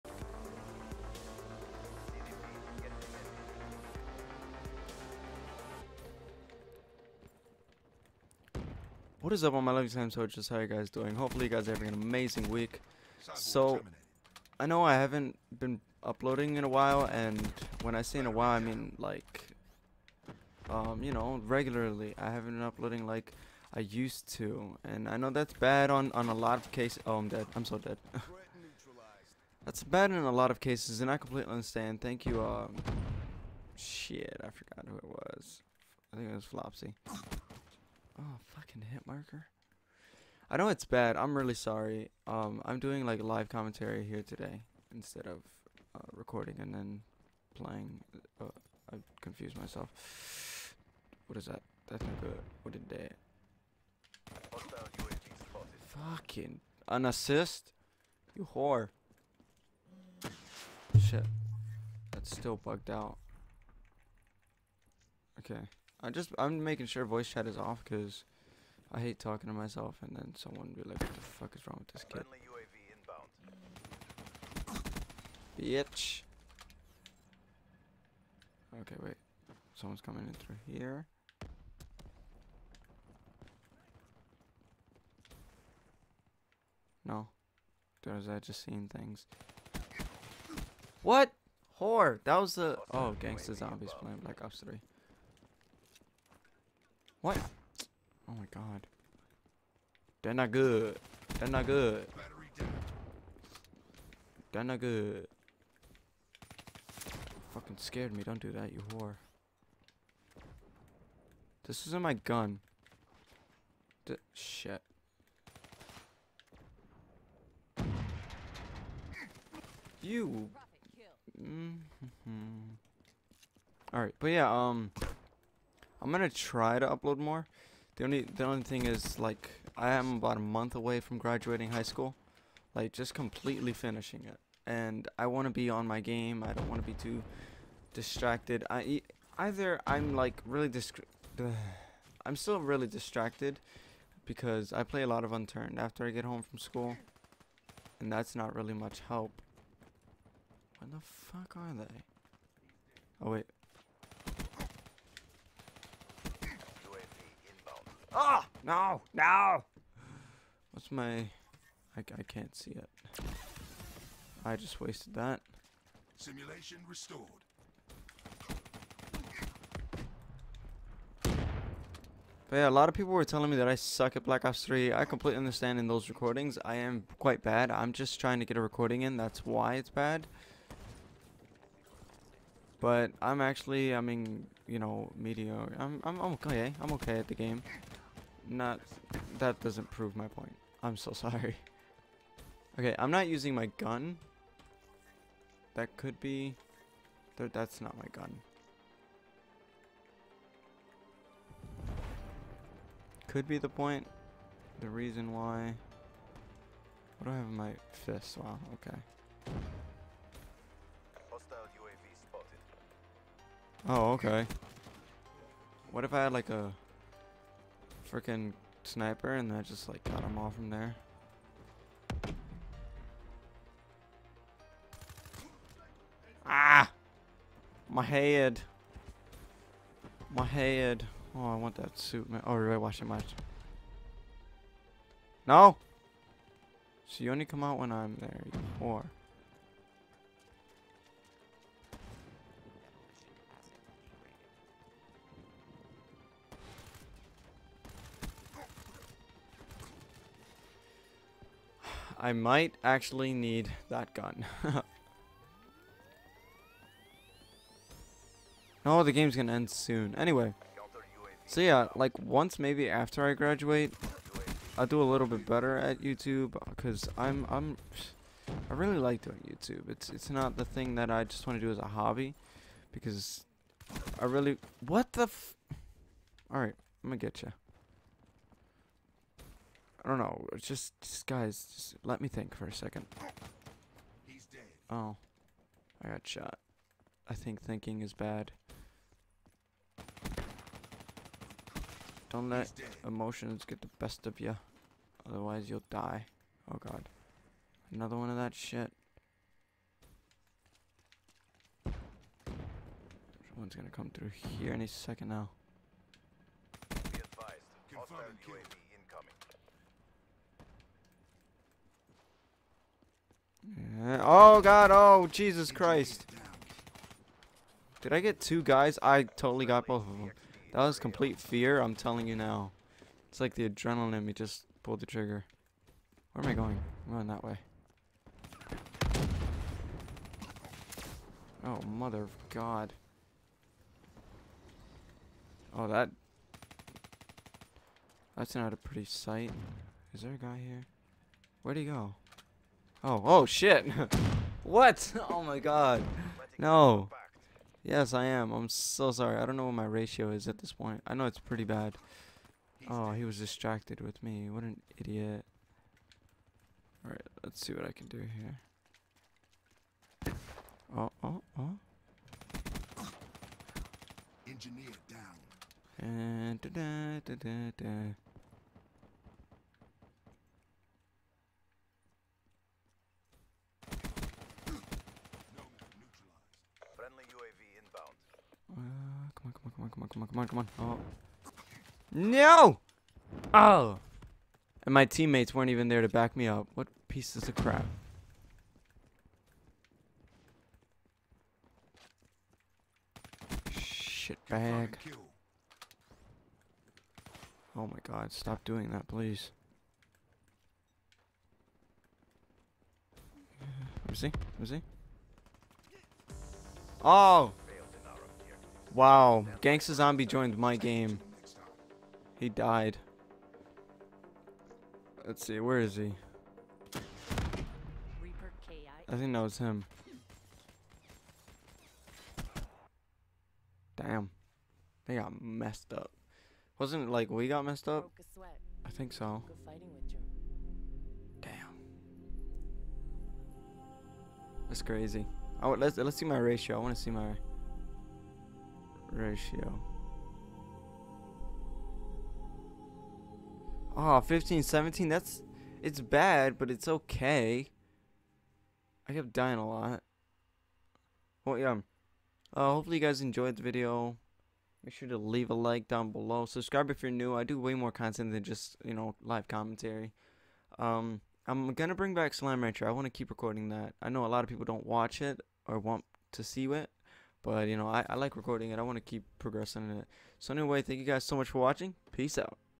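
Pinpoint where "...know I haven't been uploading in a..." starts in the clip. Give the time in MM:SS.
00:14.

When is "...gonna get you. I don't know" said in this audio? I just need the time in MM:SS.
04:37.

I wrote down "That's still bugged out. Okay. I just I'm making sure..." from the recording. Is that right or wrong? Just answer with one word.
right.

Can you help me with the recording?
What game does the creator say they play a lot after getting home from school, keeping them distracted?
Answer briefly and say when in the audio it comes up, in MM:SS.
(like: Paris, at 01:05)
Unturned, at 02:25.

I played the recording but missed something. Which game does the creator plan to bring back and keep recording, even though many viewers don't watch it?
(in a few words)
Slime Rancher.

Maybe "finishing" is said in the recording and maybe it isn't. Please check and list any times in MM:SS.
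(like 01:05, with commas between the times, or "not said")
02:13.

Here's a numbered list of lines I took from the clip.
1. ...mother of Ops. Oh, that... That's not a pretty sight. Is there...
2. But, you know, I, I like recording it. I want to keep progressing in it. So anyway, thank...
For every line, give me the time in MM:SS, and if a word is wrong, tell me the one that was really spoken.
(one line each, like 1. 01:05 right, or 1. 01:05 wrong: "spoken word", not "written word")
1. 05:31 wrong: "God", not "Ops"
2. 07:47 right.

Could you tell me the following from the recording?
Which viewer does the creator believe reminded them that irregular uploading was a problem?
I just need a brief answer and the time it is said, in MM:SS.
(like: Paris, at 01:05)
Flopsy, at 00:36.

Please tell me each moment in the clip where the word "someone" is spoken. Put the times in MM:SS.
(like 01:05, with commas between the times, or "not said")
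01:10, 01:19, 05:03.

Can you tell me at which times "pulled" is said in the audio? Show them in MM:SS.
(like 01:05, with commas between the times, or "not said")
05:24.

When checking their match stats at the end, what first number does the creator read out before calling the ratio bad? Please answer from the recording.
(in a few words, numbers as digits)
15.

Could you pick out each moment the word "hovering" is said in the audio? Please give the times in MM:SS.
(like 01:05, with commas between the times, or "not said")
not said.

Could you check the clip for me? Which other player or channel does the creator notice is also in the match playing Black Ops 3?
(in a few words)
Gangsta Zombies.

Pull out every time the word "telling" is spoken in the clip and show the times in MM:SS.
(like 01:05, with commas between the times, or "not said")
02:53, 05:21.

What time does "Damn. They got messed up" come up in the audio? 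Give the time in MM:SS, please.
07:03.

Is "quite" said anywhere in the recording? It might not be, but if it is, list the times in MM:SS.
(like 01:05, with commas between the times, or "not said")
02:57.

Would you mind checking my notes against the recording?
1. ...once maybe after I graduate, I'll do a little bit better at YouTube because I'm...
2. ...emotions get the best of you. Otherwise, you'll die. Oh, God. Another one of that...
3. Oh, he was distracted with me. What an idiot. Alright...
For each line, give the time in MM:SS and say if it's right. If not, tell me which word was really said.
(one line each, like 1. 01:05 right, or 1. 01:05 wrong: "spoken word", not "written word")
1. 04:22 right
2. 04:53 right
3. 05:52 right.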